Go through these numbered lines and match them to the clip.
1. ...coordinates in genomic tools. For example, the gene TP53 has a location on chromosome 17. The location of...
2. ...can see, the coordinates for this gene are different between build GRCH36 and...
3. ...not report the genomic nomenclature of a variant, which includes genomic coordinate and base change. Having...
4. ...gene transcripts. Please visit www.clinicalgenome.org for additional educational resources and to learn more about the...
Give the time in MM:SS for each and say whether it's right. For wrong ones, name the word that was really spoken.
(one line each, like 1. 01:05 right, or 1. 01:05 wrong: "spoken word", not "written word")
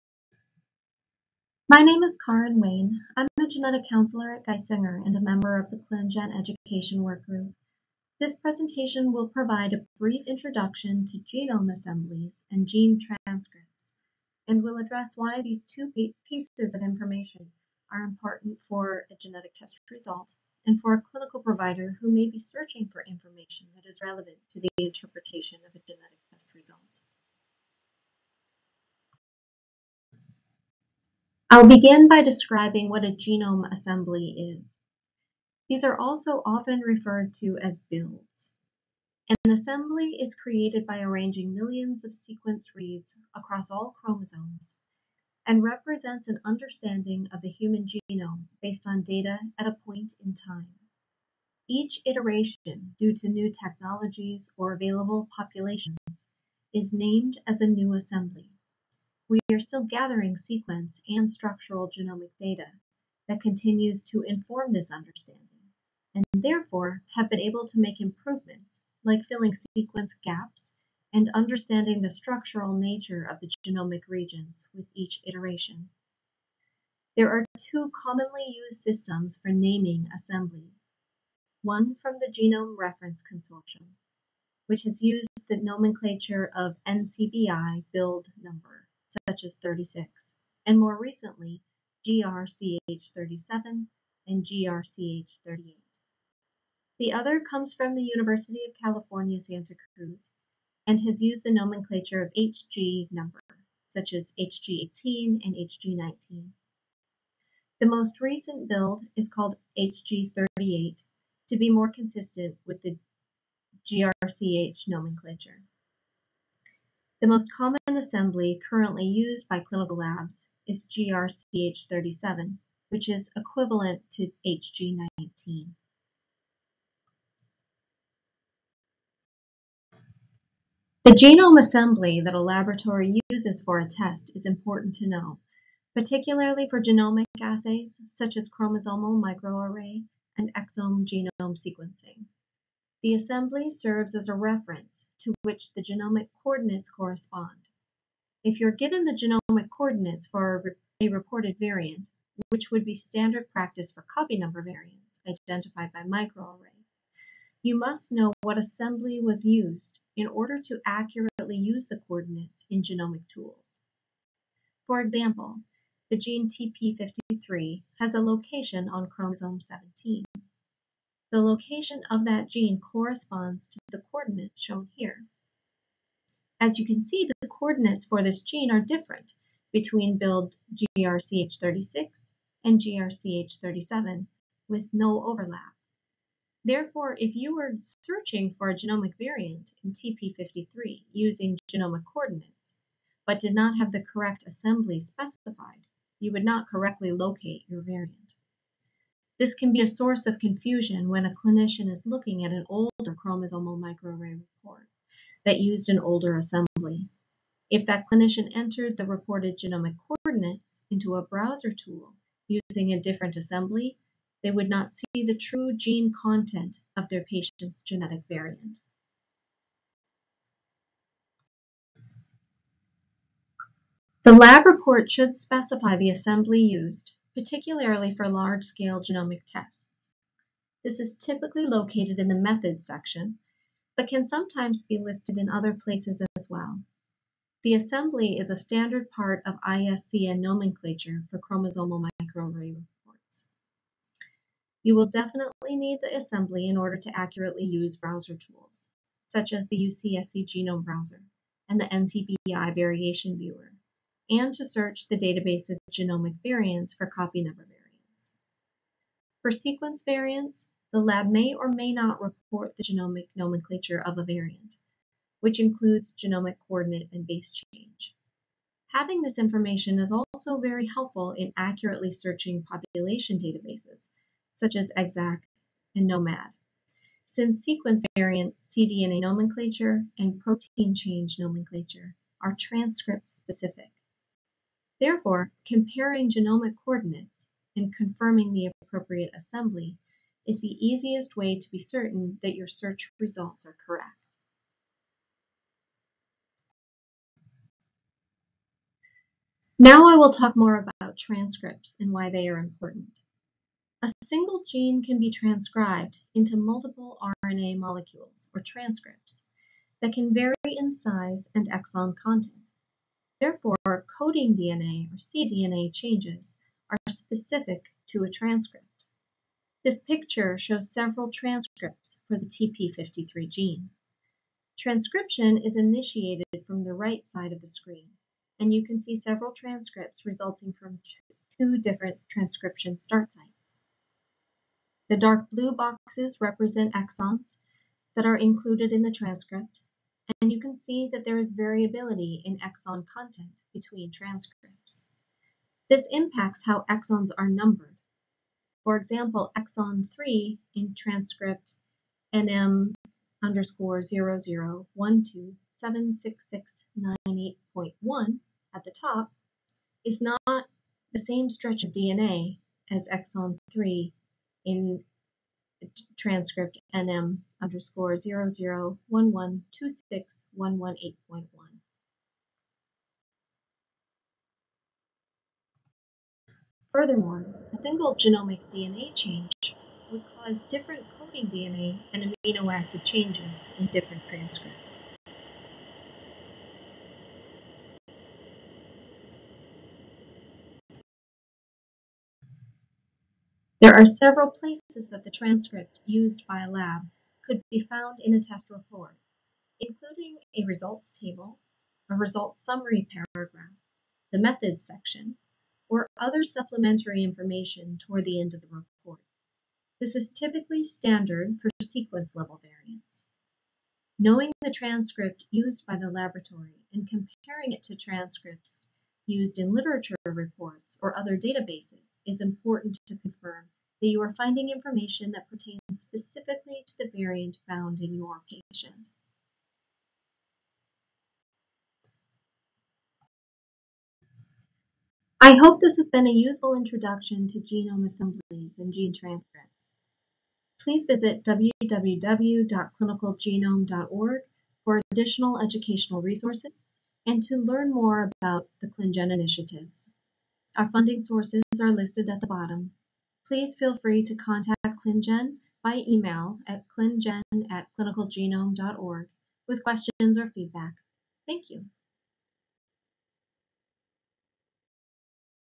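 1. 02:41 right
2. 02:56 right
3. 04:21 right
4. 07:18 right.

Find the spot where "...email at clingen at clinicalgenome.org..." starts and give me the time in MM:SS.
07:36.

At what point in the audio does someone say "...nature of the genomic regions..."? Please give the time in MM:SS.
01:12.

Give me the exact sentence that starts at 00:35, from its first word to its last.
These are also often referred to as builds.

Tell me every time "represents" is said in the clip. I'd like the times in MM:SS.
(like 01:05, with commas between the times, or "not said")
00:45, 05:36.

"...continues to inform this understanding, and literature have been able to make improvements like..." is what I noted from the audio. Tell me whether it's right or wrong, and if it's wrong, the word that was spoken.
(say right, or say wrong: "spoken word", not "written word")
wrong: "therefore", not "literature".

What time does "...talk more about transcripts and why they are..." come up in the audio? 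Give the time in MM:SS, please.
05:00.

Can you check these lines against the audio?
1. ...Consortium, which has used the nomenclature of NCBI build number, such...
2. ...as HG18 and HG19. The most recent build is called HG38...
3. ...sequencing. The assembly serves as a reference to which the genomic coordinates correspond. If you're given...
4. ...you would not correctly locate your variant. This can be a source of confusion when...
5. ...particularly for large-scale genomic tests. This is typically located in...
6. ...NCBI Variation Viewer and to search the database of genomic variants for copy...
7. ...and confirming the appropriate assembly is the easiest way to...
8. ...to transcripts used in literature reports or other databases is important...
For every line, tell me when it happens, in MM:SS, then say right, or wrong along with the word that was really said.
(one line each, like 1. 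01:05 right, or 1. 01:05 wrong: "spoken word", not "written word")
1. 01:23 right
2. 01:44 right
3. 02:21 right
4. 03:16 right
5. 03:47 right
6. 04:11 right
7. 04:47 right
8. 06:57 right.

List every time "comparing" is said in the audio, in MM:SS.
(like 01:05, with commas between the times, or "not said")
04:45, 06:57.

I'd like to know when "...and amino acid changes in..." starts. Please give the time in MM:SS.
06:22.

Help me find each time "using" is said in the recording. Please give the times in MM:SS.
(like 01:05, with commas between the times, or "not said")
03:11, 03:32.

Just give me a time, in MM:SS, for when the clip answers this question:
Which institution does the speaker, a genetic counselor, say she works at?
00:04.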